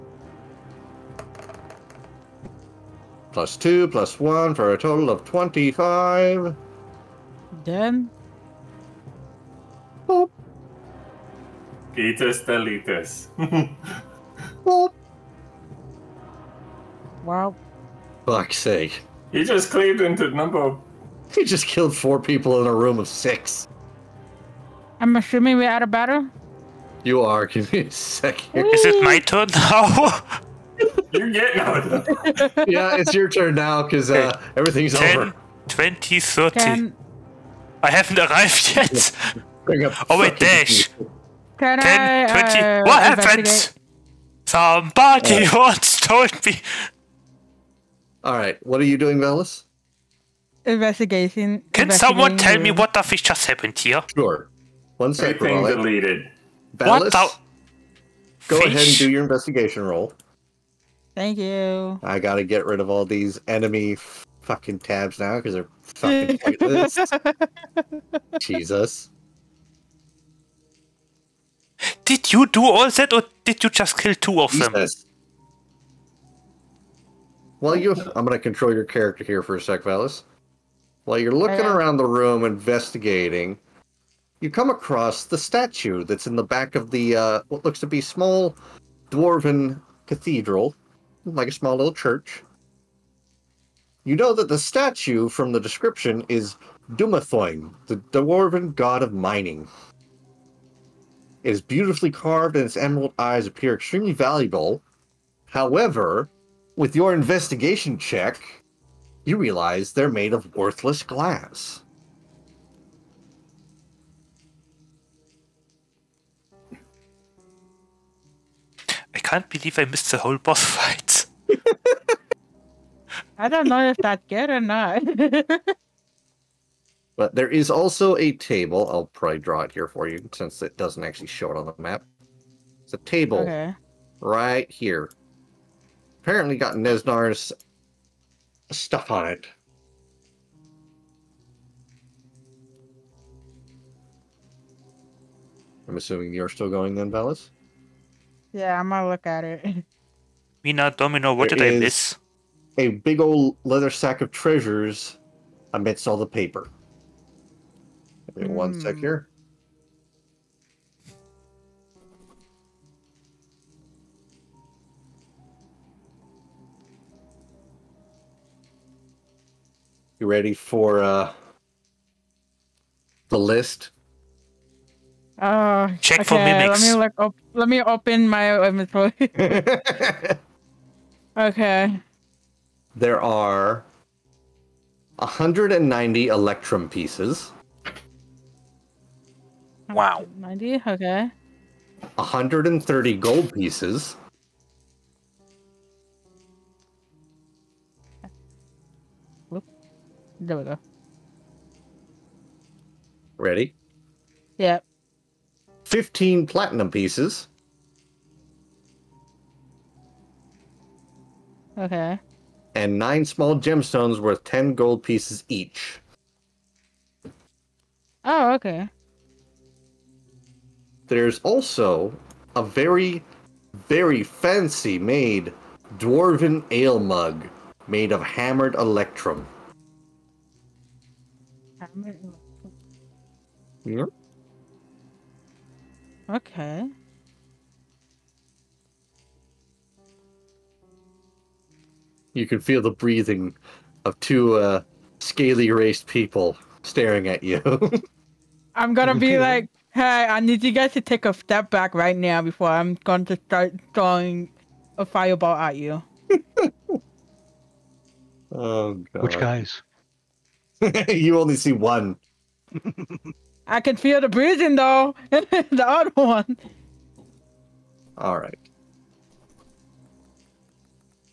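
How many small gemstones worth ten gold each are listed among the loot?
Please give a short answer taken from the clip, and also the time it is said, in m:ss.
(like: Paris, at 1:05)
9, at 3:32.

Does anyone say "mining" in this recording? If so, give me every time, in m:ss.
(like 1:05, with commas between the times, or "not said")
1:39.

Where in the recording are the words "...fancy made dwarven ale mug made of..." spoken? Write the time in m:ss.
3:44.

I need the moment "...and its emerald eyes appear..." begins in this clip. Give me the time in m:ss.
1:42.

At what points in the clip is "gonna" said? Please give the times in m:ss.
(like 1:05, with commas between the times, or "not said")
1:18, 2:28, 4:08.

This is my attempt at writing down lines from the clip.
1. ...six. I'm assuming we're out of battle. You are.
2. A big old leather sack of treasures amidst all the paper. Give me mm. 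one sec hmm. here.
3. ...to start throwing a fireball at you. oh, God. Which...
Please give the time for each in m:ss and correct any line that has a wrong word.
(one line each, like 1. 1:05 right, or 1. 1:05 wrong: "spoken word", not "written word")
1. 0:23 right
2. 2:32 right
3. 4:13 right.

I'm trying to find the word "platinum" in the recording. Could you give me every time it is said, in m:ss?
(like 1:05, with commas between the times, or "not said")
3:26.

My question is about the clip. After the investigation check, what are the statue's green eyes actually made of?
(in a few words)
worthless glass.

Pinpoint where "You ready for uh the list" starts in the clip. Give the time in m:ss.
2:50.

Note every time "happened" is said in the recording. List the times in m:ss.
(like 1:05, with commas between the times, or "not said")
0:43, 0:53.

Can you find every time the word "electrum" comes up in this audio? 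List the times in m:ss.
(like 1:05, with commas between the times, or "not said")
3:06, 3:48.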